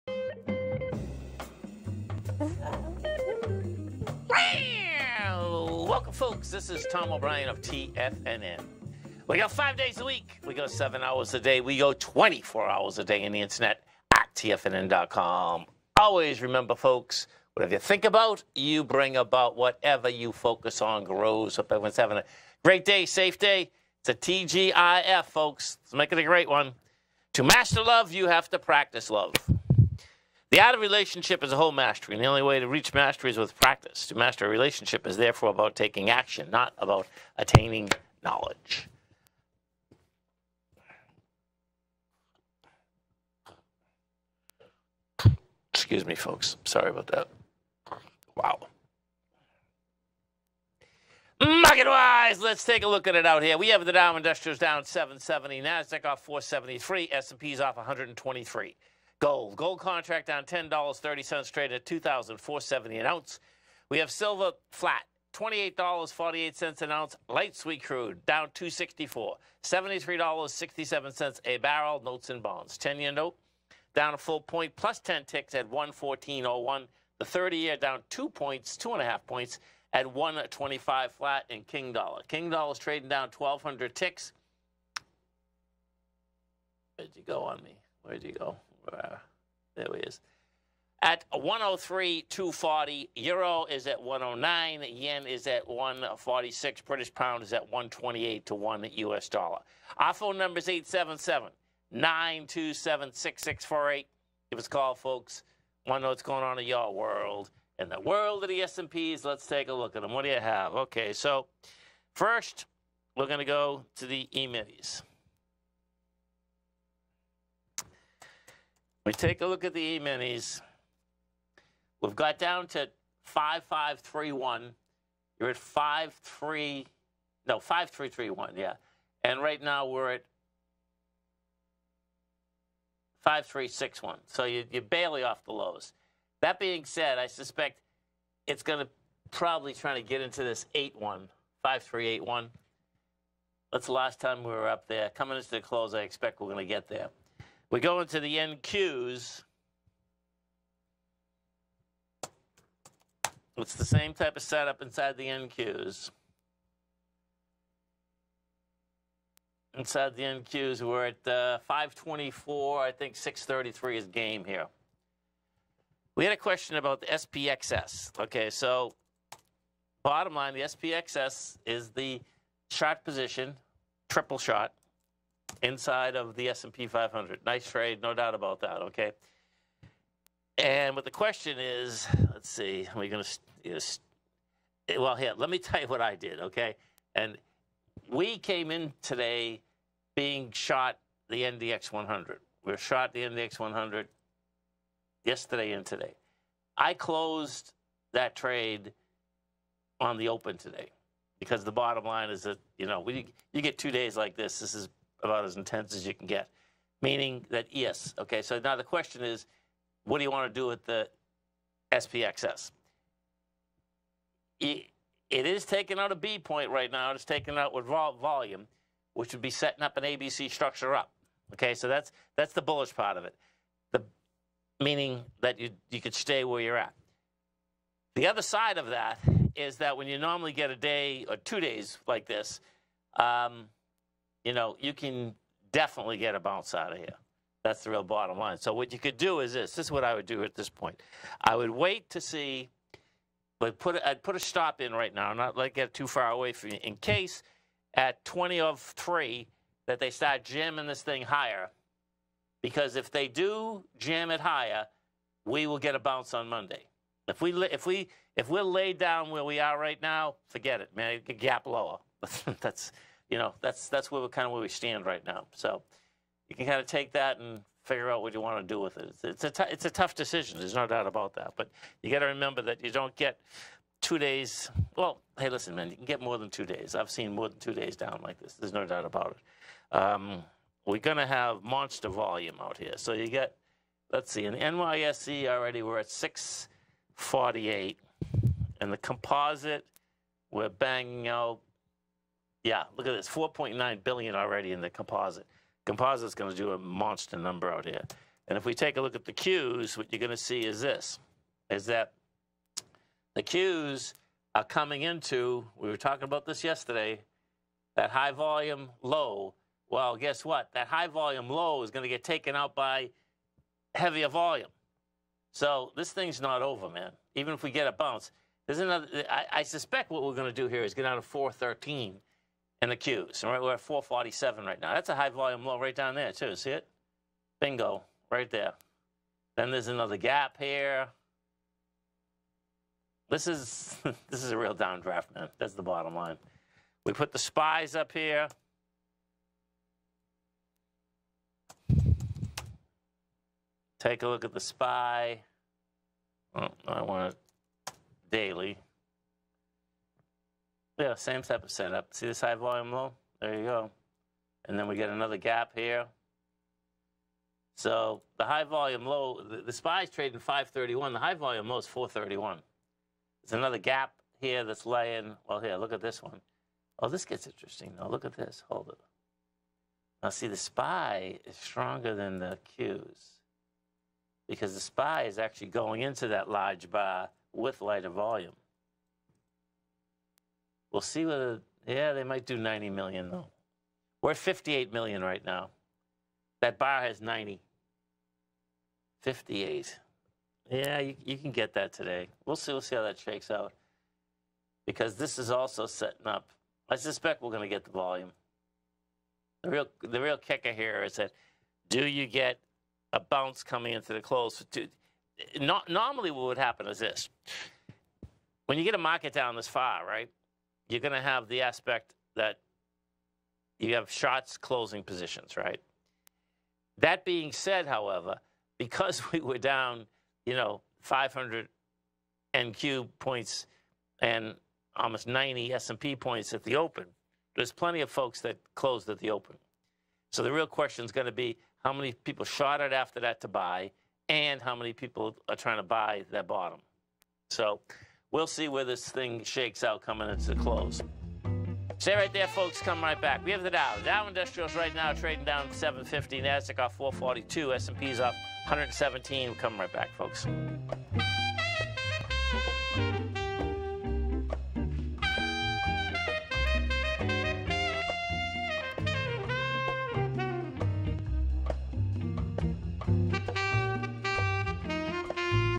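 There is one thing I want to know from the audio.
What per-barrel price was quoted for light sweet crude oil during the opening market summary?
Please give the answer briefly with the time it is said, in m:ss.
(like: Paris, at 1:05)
$73.67, at 1:09.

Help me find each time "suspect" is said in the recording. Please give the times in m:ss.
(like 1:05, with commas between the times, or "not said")
2:17, 5:19, 6:36.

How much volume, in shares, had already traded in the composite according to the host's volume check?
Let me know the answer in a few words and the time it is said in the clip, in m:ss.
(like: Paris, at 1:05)
4.9 billion, at 4:53.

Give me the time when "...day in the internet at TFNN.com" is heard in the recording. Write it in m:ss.
0:13.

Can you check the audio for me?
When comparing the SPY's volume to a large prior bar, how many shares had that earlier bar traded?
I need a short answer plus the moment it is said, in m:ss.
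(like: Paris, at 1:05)
90 million, at 6:22.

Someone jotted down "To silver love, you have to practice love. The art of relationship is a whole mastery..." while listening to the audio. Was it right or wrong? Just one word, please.
wrong.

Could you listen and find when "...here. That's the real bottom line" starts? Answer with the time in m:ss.
3:56.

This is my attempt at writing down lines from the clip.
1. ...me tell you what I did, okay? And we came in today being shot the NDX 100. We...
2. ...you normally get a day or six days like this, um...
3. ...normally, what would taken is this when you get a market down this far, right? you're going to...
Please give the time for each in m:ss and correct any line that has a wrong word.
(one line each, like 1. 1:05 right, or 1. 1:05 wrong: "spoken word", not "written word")
1. 3:05 right
2. 3:50 wrong: "two", not "six"
3. 6:45 wrong: "happen", not "taken".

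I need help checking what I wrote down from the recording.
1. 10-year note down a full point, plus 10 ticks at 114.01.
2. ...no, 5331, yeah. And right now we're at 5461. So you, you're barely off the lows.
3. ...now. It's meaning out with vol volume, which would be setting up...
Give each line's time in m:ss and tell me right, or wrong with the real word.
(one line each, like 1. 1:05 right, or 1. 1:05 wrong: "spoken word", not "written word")
1. 1:12 right
2. 2:07 wrong: "5361", not "5461"
3. 3:36 wrong: "taking", not "meaning".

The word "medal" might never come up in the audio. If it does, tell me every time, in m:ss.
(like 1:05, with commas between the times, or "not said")
not said.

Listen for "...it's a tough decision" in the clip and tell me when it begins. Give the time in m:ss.
4:29.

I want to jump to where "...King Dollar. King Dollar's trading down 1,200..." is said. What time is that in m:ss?
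1:21.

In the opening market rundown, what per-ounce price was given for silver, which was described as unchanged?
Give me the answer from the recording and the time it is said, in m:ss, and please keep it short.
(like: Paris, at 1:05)
$28.48, at 1:05.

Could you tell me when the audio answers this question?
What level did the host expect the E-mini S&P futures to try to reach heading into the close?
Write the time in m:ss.
2:21.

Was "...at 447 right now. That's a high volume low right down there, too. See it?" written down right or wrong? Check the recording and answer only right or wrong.
right.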